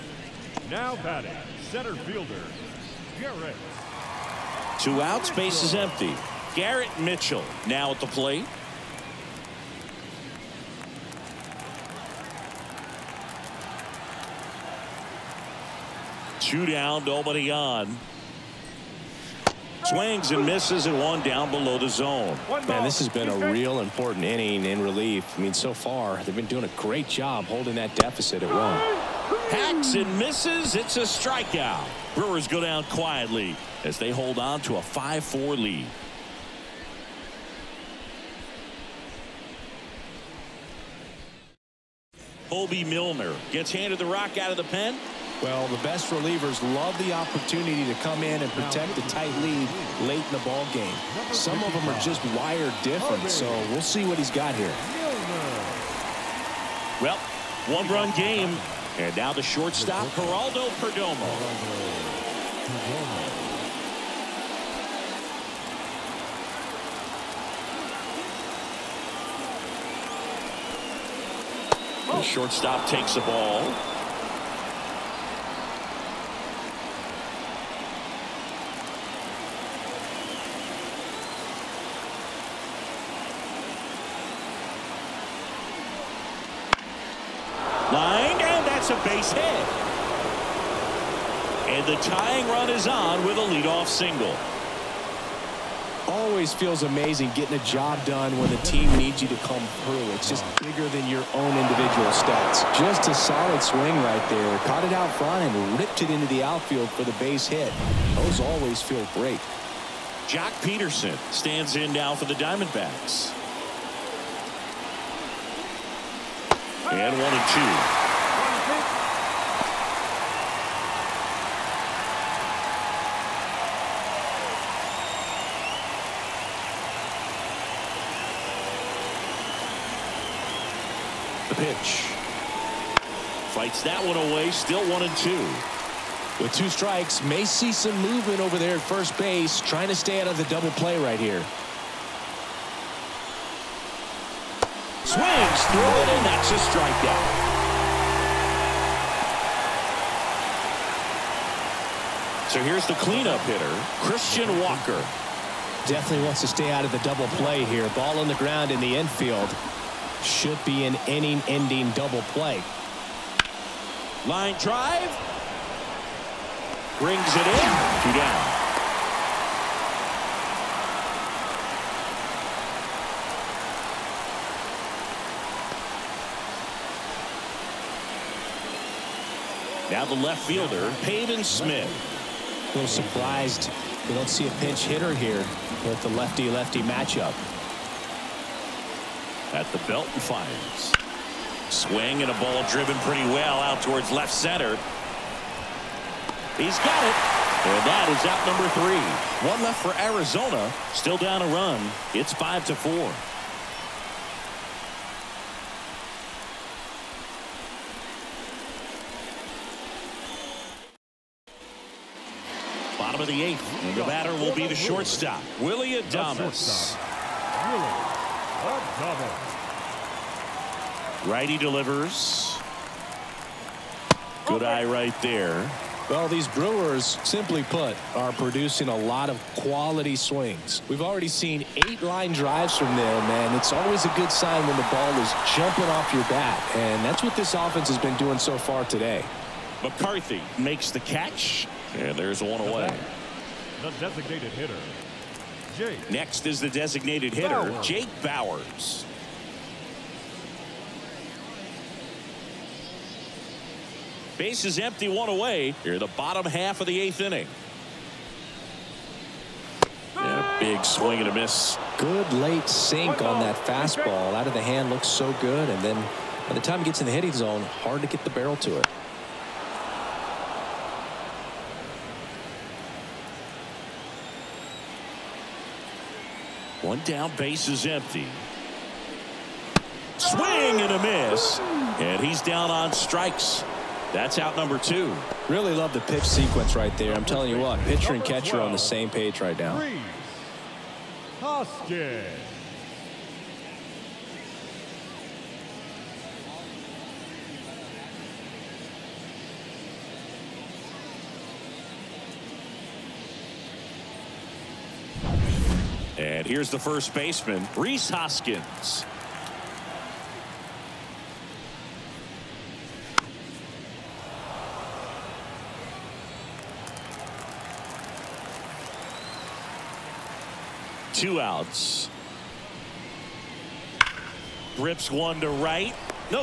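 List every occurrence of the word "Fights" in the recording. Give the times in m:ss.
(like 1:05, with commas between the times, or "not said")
2:13.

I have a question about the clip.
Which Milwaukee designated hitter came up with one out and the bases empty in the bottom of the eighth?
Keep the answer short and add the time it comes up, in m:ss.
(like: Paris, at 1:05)
Jake Bauers, at 4:07.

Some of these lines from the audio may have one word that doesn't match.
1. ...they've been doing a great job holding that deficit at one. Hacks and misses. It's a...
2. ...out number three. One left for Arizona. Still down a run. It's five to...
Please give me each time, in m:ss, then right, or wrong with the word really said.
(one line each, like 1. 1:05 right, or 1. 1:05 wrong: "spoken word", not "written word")
1. 0:26 right
2. 3:18 right.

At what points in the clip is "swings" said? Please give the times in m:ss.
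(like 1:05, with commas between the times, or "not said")
0:19, 1:43, 2:25, 3:11, 3:50, 4:20, 4:40.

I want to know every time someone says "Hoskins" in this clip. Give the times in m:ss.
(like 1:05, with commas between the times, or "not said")
4:51, 5:08.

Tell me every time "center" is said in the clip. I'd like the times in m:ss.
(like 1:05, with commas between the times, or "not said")
0:01, 3:14.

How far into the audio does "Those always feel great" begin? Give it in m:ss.
1:48.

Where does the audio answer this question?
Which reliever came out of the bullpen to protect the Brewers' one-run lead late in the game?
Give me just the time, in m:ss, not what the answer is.
0:42.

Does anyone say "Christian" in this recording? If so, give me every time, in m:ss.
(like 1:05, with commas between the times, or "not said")
2:34.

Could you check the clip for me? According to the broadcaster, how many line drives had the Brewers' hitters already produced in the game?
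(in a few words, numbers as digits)
8.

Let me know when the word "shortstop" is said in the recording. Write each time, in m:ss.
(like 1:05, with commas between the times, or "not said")
0:59, 1:12, 3:34.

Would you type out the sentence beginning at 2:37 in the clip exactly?
Ball on the ground in the infield.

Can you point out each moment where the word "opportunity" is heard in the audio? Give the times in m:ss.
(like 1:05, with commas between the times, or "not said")
0:47.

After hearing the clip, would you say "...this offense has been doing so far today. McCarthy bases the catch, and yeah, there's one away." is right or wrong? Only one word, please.
wrong.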